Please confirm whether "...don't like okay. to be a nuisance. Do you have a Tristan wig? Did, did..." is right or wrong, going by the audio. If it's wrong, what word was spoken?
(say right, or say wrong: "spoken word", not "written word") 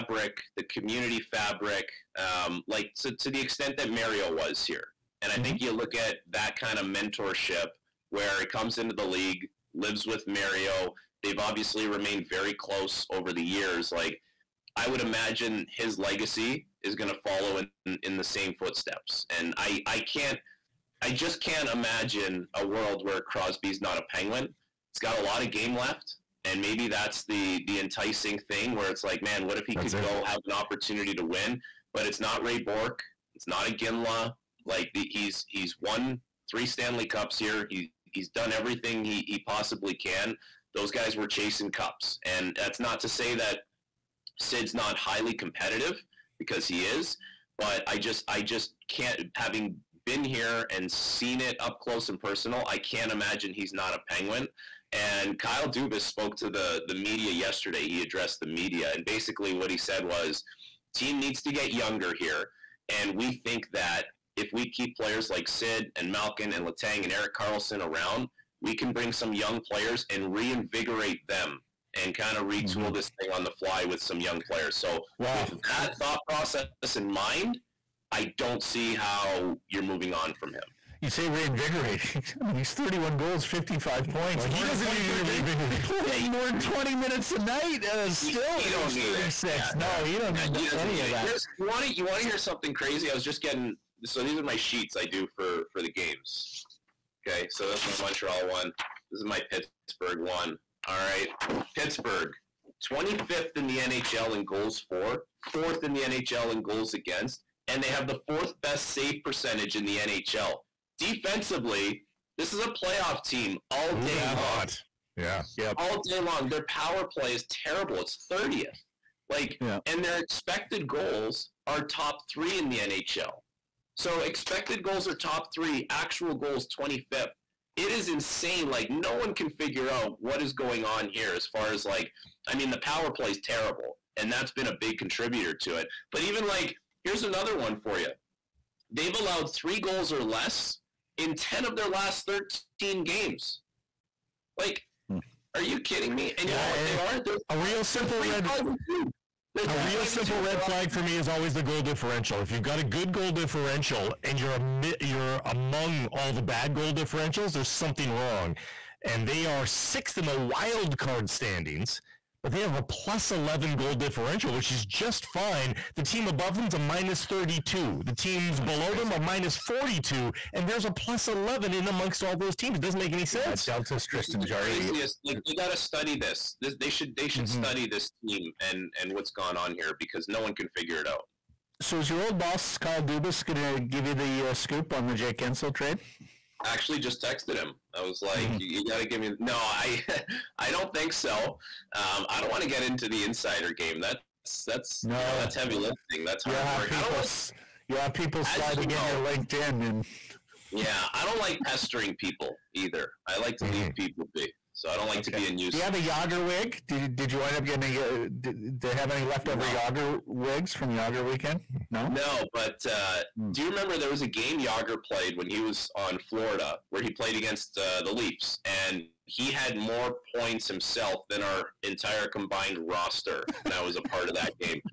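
wrong: "Jagr", not "Tristan".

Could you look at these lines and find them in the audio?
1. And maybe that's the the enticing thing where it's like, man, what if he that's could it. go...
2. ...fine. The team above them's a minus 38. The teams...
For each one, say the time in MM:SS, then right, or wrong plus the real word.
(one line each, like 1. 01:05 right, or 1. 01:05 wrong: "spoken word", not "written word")
1. 00:26 right
2. 02:45 wrong: "32", not "38".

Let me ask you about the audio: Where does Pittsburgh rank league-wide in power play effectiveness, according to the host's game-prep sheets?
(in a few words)
30th.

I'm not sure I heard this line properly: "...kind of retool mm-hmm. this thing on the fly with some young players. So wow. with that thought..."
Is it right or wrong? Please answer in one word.
right.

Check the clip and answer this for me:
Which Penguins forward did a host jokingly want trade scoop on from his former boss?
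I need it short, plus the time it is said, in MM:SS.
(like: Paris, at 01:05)
Jake Guentzel, at 03:05.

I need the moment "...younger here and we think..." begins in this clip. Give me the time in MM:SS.
01:01.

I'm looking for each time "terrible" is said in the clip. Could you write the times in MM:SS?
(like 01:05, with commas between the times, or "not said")
01:57, 02:13.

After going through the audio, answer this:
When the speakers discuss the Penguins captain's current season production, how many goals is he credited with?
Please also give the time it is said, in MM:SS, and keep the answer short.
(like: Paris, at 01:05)
31, at 01:22.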